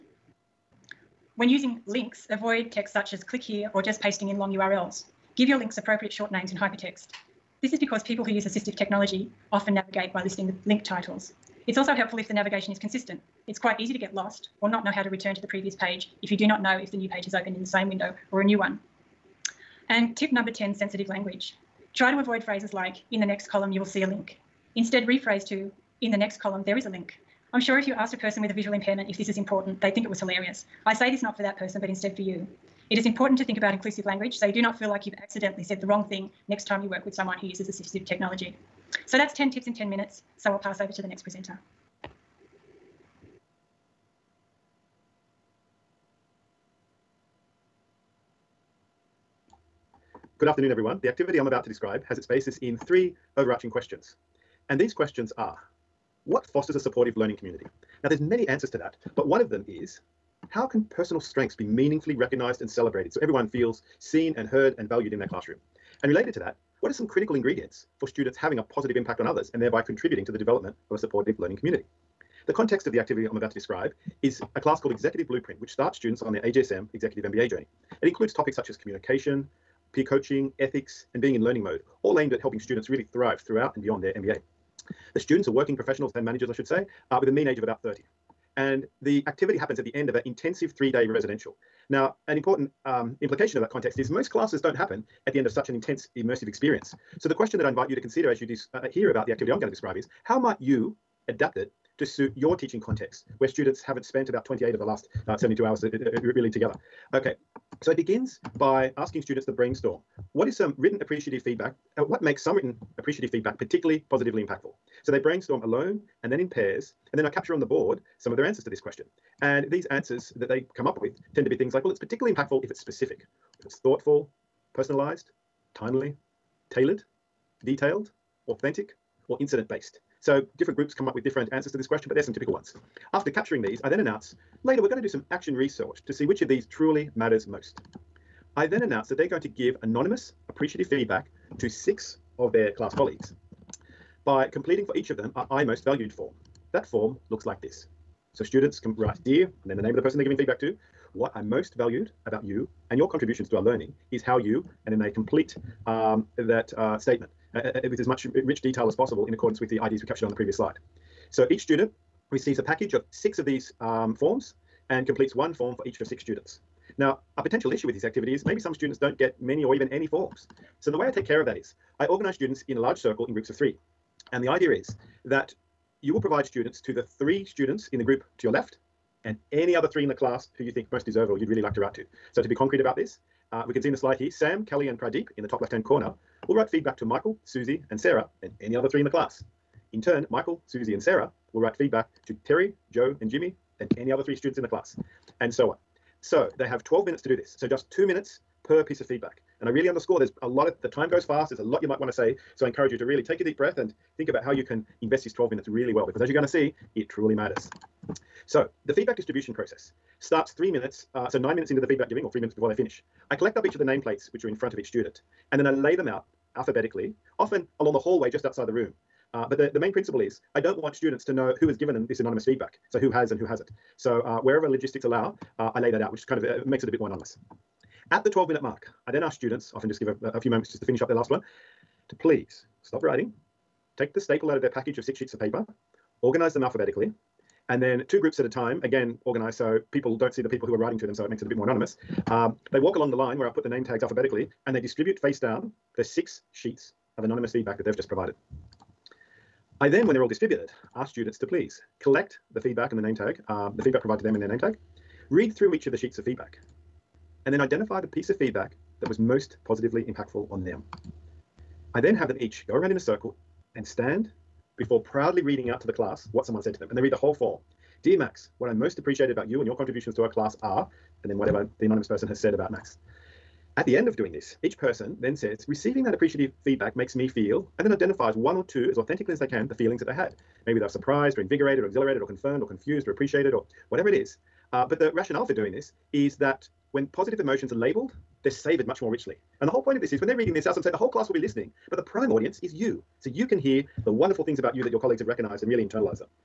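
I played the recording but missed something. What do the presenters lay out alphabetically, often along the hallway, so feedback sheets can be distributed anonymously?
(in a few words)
Nameplates.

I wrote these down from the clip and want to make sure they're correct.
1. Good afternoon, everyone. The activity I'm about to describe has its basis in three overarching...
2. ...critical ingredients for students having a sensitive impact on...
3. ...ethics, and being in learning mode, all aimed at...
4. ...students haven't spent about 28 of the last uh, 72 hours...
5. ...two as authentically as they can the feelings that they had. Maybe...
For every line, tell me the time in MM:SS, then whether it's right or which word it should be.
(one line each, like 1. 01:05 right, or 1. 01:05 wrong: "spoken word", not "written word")
1. 00:50 right
2. 01:07 wrong: "positive", not "sensitive"
3. 01:20 right
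4. 01:43 right
5. 04:38 right.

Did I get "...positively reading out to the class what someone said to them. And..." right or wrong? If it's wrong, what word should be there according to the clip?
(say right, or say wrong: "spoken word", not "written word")
wrong: "proudly", not "positively".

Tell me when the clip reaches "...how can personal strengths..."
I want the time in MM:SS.
01:00.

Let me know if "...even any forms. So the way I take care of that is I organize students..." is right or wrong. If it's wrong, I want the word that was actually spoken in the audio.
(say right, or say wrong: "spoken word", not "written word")
right.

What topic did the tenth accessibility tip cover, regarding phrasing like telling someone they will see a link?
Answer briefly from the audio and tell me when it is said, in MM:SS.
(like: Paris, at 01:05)
Sensitive language, at 00:20.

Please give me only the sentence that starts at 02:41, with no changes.
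So each student receives a package of six of these um, forms and completes one form for each of six students.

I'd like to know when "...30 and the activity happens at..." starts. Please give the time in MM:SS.
01:27.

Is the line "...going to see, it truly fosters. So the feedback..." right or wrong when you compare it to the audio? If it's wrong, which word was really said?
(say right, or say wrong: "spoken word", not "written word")
wrong: "matters", not "fosters".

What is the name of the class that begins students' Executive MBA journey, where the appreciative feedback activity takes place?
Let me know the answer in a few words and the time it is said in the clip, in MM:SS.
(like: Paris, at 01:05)
Executive Blueprint, at 01:14.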